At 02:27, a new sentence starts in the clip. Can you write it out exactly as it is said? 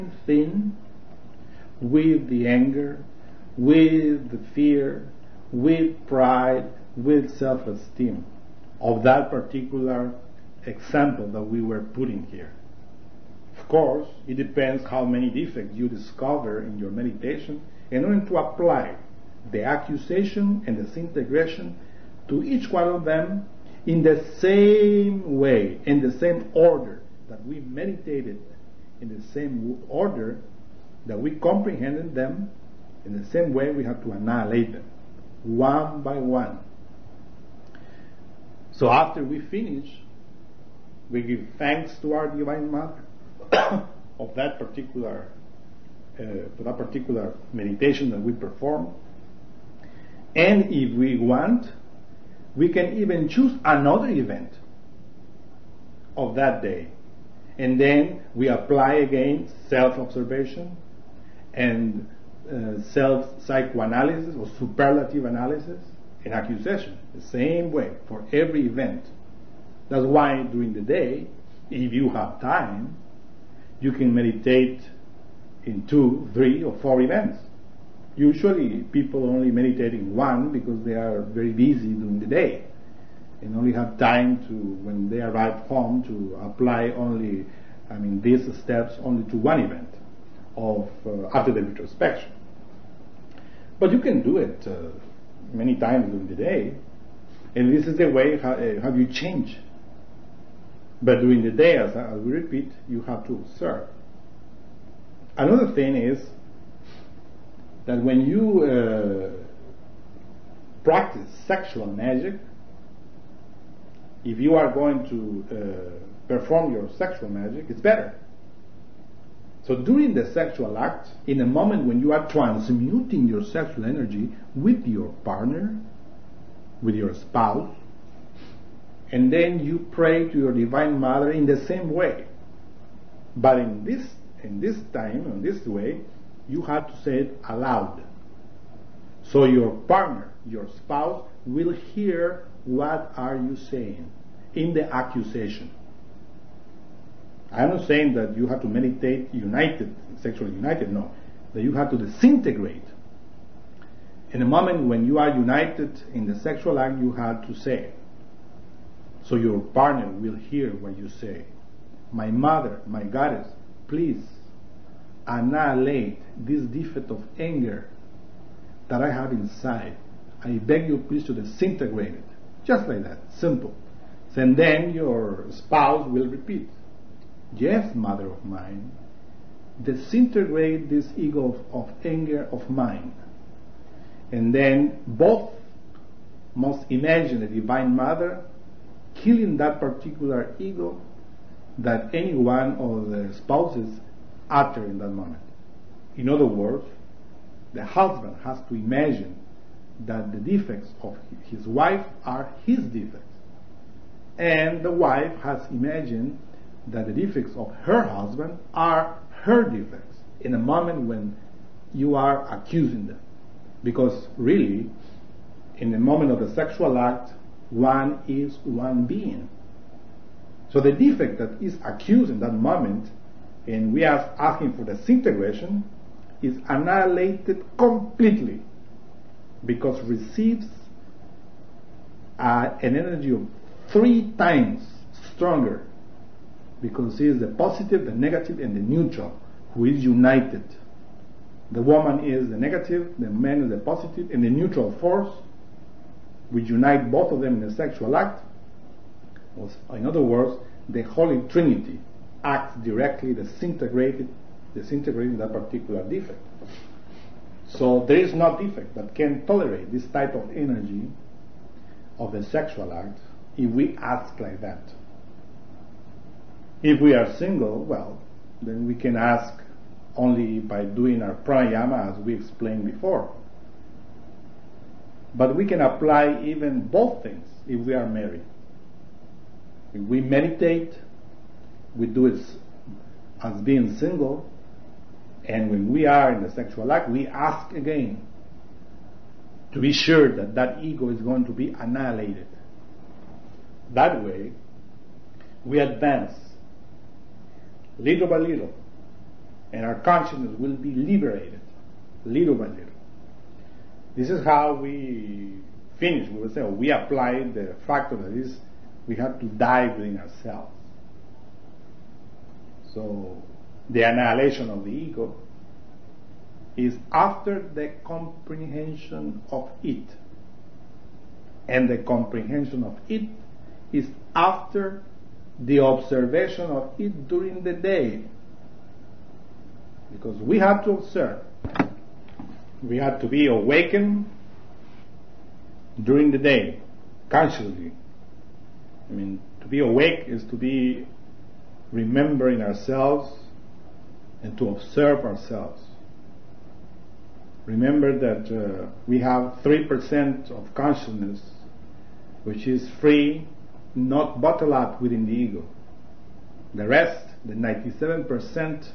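I'm not saying that you have to meditate united, sexually united, no.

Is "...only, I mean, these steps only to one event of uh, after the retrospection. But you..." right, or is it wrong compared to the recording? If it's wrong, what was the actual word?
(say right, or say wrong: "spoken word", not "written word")
right.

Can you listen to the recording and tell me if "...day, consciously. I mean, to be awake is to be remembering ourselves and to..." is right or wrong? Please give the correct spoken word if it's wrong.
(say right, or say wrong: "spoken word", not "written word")
right.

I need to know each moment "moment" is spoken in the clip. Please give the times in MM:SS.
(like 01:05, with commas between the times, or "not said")
02:01, 02:34, 03:15, 03:30, 03:35, 03:42.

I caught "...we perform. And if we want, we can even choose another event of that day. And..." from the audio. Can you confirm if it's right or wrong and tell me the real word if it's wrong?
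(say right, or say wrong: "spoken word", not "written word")
right.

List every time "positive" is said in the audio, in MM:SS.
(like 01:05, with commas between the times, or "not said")
03:57, 04:03.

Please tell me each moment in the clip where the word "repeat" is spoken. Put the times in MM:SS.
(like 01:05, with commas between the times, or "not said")
01:42, 02:56.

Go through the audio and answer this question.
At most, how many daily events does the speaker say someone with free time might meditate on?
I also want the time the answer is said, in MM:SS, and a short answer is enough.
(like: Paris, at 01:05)
4, at 01:16.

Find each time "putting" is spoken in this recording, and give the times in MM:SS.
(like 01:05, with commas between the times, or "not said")
00:11.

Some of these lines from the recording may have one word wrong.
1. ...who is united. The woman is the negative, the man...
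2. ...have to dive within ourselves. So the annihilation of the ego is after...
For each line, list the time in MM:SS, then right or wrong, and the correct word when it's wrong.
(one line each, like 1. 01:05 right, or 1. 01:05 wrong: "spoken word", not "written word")
1. 03:59 right
2. 05:09 right.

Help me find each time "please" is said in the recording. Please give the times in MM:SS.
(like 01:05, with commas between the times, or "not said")
02:43, 02:51.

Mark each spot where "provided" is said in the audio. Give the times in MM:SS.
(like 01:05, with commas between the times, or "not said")
not said.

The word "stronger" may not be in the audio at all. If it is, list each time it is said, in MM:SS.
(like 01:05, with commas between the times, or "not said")
03:55.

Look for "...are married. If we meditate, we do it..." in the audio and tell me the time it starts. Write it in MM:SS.
04:37.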